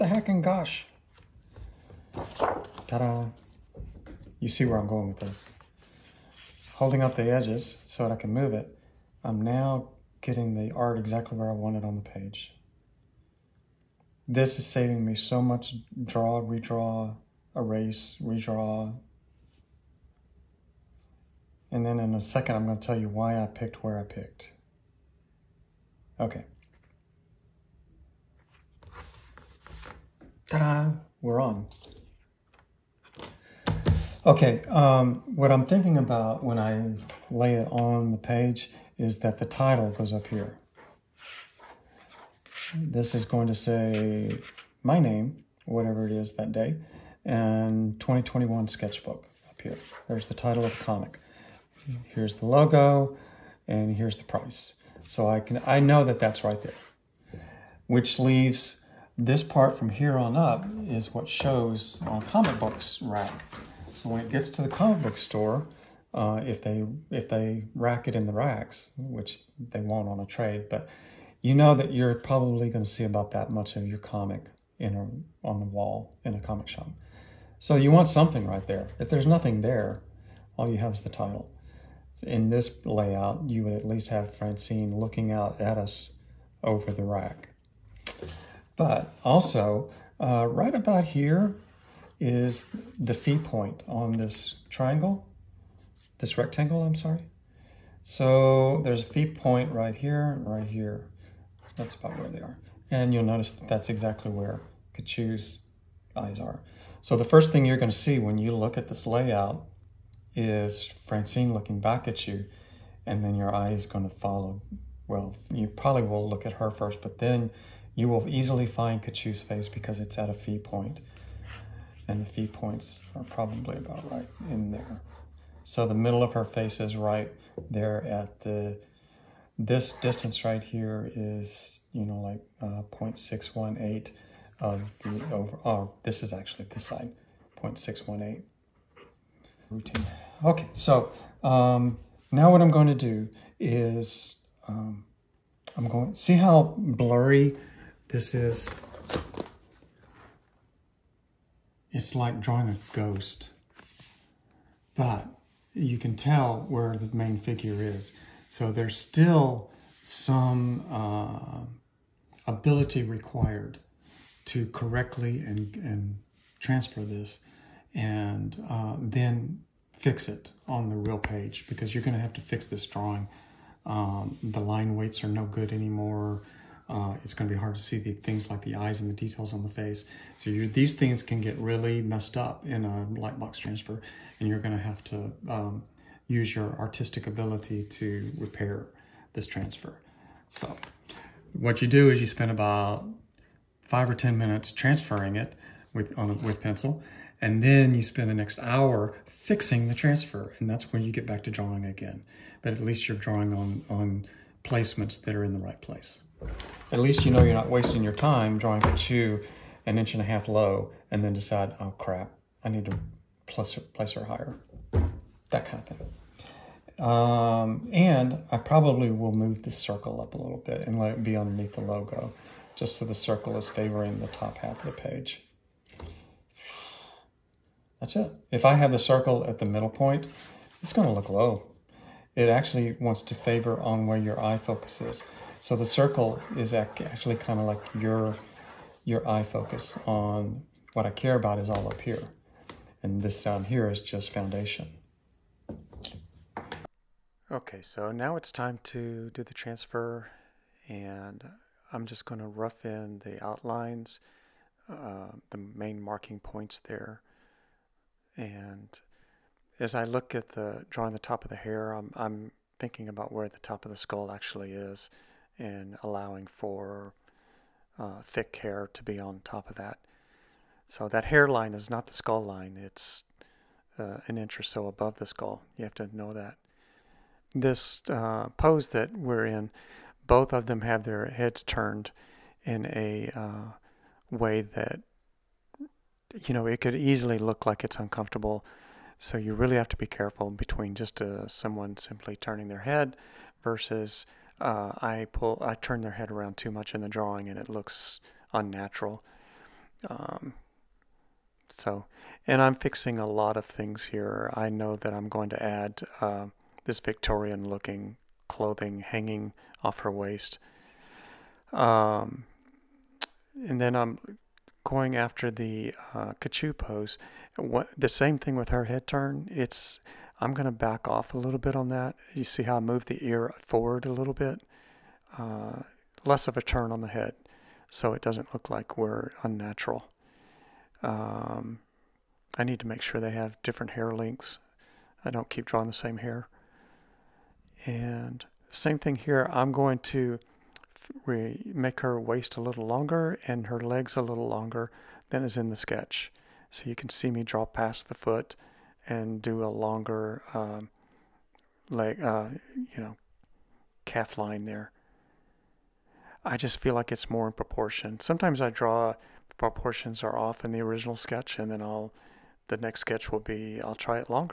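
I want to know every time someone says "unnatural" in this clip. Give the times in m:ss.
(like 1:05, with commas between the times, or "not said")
4:58, 5:29.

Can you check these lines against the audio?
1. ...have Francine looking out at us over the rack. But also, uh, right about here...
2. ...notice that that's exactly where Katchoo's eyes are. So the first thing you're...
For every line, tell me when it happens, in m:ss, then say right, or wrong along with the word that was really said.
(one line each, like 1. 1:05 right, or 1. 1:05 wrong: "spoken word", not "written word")
1. 1:24 right
2. 1:43 right.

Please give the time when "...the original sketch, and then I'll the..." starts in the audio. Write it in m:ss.
6:00.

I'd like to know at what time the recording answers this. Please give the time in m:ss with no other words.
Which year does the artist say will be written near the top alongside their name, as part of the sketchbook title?
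0:47.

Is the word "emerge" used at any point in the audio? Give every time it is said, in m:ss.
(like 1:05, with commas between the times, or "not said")
not said.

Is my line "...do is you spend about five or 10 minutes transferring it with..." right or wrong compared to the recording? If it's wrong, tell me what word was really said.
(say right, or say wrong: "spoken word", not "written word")
right.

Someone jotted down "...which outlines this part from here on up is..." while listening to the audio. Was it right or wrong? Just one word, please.
wrong.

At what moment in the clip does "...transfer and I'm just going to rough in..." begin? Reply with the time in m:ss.
4:09.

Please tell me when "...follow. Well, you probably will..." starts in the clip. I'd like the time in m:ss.
1:54.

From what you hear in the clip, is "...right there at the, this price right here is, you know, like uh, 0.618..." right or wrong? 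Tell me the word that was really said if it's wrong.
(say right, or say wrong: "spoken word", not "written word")
wrong: "distance", not "price".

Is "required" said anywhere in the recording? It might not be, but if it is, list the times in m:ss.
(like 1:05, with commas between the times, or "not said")
2:43.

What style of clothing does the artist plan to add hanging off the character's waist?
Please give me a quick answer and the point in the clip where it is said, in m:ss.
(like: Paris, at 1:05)
Victorian, at 5:06.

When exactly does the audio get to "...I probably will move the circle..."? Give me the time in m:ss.
3:38.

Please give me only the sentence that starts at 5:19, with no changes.
It's I'm going to back off a little bit on that.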